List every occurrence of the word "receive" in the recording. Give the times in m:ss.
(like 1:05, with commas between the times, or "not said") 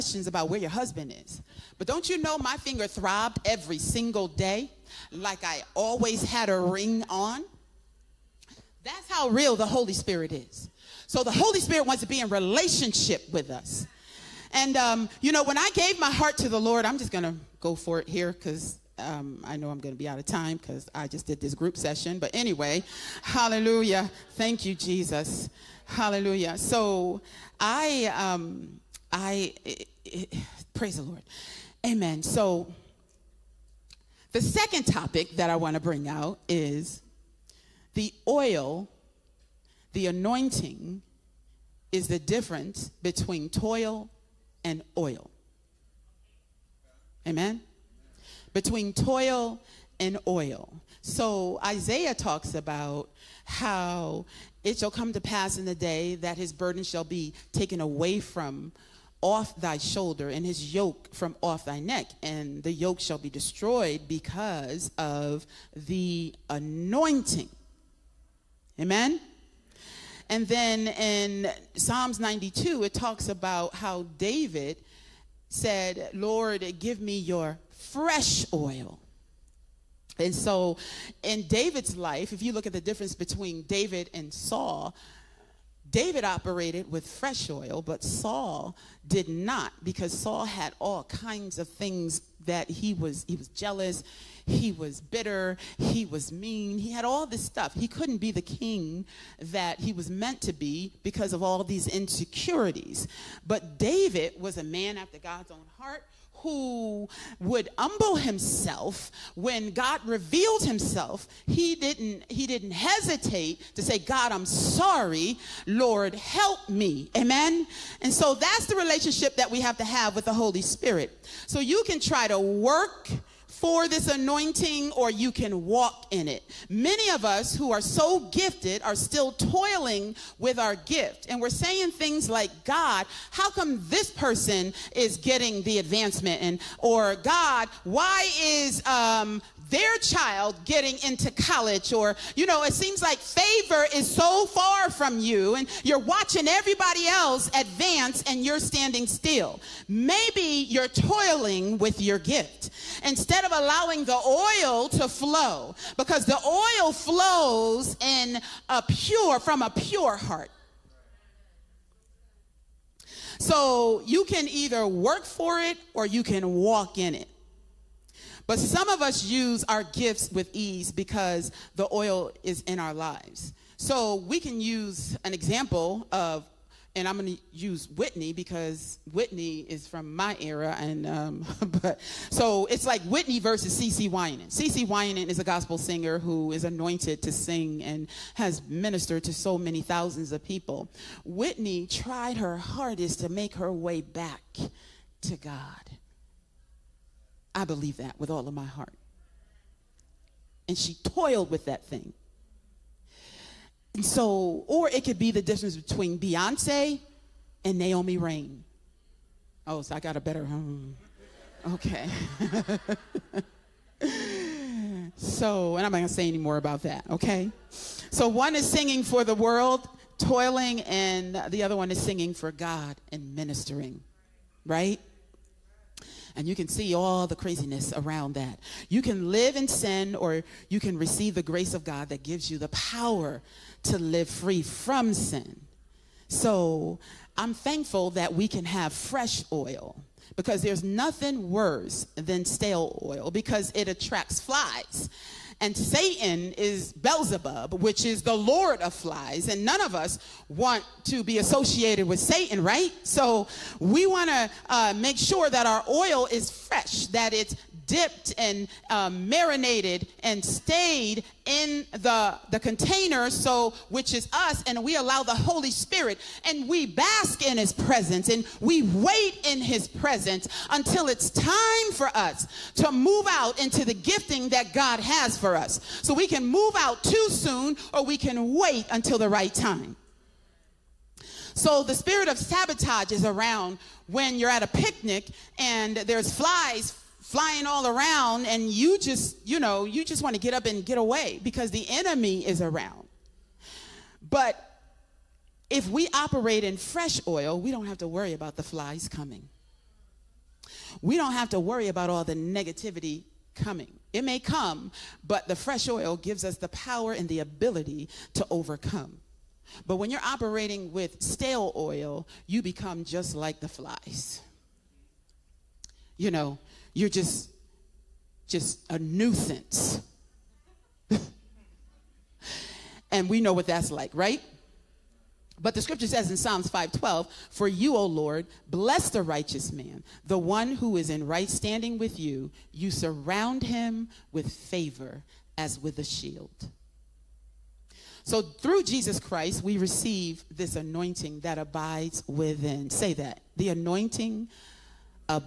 3:50, 5:39.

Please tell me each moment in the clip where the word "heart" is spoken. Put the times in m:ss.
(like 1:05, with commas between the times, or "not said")
0:16, 1:45, 2:40, 3:18.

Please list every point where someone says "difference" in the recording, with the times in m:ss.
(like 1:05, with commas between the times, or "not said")
0:42, 1:22, 3:25.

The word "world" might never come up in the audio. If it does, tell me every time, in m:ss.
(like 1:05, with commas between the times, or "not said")
3:39.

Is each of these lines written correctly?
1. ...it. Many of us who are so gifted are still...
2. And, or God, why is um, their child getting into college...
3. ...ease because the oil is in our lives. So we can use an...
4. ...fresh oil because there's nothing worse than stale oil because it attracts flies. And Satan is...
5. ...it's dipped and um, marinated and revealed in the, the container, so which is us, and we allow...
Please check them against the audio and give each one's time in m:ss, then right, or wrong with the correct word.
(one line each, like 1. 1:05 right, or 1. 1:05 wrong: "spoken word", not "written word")
1. 2:06 right
2. 2:16 right
3. 2:50 right
4. 3:58 right
5. 4:17 wrong: "stayed", not "revealed".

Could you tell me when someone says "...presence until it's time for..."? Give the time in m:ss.
4:29.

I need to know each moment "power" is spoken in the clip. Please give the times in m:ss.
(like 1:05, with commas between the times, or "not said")
3:52, 5:06.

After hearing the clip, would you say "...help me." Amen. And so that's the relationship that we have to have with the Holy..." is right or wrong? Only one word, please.
right.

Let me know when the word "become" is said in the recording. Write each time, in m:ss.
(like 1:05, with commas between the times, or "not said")
5:12.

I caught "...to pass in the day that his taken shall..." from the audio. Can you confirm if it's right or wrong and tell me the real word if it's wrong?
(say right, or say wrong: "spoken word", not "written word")
wrong: "burden", not "taken".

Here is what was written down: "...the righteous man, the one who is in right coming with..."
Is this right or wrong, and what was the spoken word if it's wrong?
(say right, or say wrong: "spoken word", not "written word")
wrong: "standing", not "coming".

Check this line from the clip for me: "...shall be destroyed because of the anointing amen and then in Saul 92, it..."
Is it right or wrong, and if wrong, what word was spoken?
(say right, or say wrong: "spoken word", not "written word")
wrong: "Psalms", not "Saul".